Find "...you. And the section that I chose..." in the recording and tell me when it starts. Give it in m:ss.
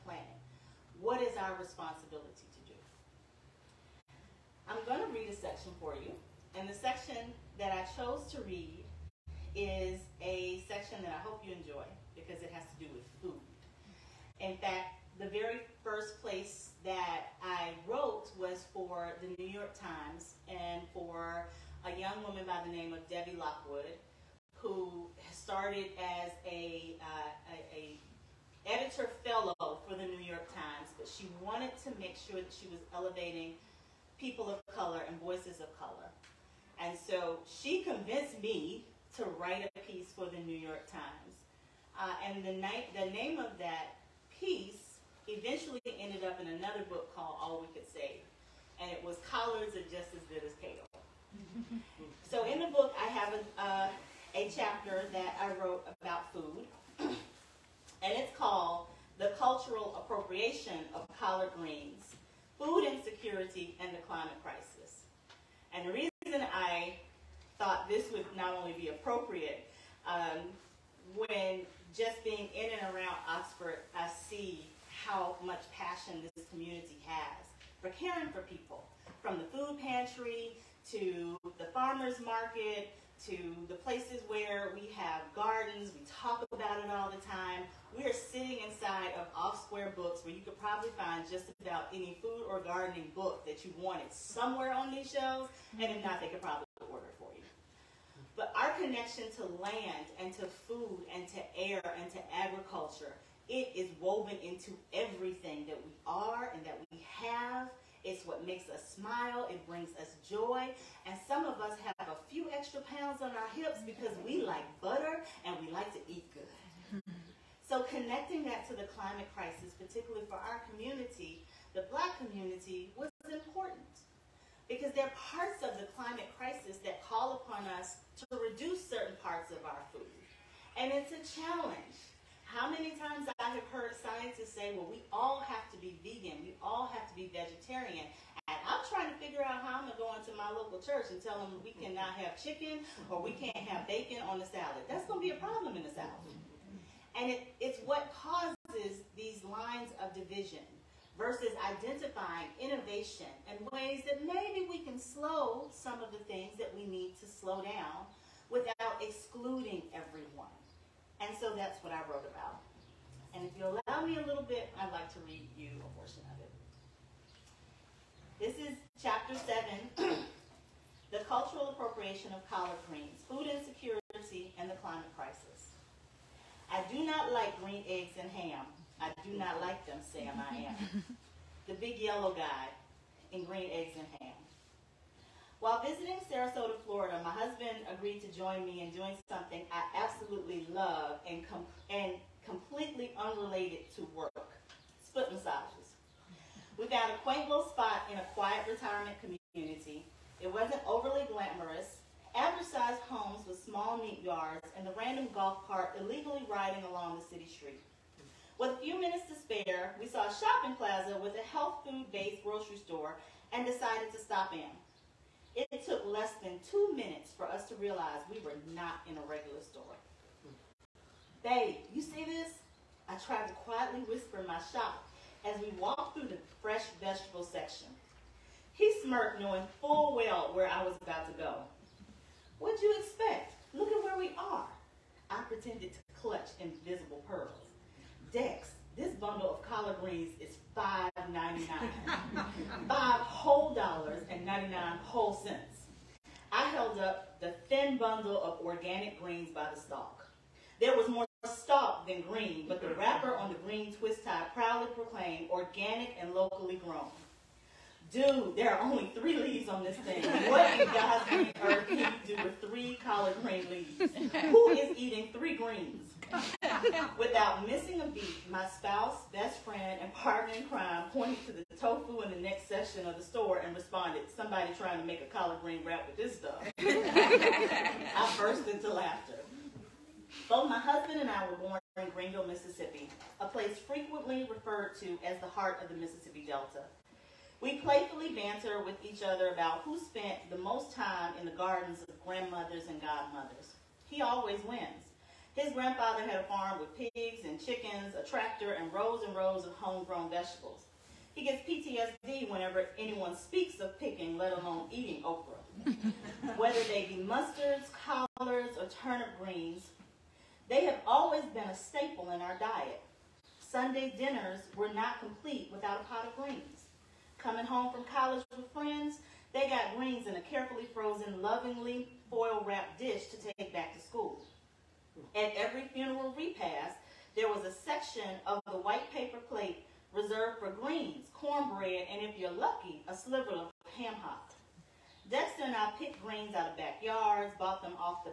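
0:06.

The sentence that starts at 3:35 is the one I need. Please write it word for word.
It took less than two minutes for us to realize we were not in a regular store.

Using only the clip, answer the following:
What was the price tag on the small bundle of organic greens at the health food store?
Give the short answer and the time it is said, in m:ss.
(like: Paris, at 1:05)
$5.99, at 4:00.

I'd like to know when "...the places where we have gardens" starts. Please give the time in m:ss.
1:23.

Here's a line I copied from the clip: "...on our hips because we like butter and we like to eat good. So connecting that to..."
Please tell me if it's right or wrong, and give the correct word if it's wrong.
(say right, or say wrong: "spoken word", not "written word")
right.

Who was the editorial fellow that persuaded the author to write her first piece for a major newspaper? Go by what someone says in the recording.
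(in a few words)
Devi Lockwood.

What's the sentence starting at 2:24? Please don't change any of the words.
That's going to be a problem in the South.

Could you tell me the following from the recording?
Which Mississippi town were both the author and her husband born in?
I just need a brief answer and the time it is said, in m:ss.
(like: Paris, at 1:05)
Greenville, at 4:42.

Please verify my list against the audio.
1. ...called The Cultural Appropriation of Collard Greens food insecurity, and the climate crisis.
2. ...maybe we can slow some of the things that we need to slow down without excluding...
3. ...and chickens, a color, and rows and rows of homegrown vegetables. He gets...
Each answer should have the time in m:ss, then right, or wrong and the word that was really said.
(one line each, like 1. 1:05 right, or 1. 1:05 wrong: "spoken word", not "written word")
1. 0:58 right
2. 2:34 right
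3. 4:57 wrong: "tractor", not "color".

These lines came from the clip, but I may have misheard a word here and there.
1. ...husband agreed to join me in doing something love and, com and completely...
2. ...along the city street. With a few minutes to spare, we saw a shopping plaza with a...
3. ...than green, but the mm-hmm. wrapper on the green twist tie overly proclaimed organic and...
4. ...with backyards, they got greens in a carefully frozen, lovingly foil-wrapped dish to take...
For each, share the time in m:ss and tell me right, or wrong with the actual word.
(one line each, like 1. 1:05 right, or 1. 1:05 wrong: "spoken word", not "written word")
1. 3:07 right
2. 3:26 right
3. 4:12 wrong: "proudly", not "overly"
4. 5:18 wrong: "friends", not "backyards".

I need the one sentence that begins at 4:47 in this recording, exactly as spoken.
We playfully banter with each other about who spent the most time in the gardens of grandmothers and godmothers.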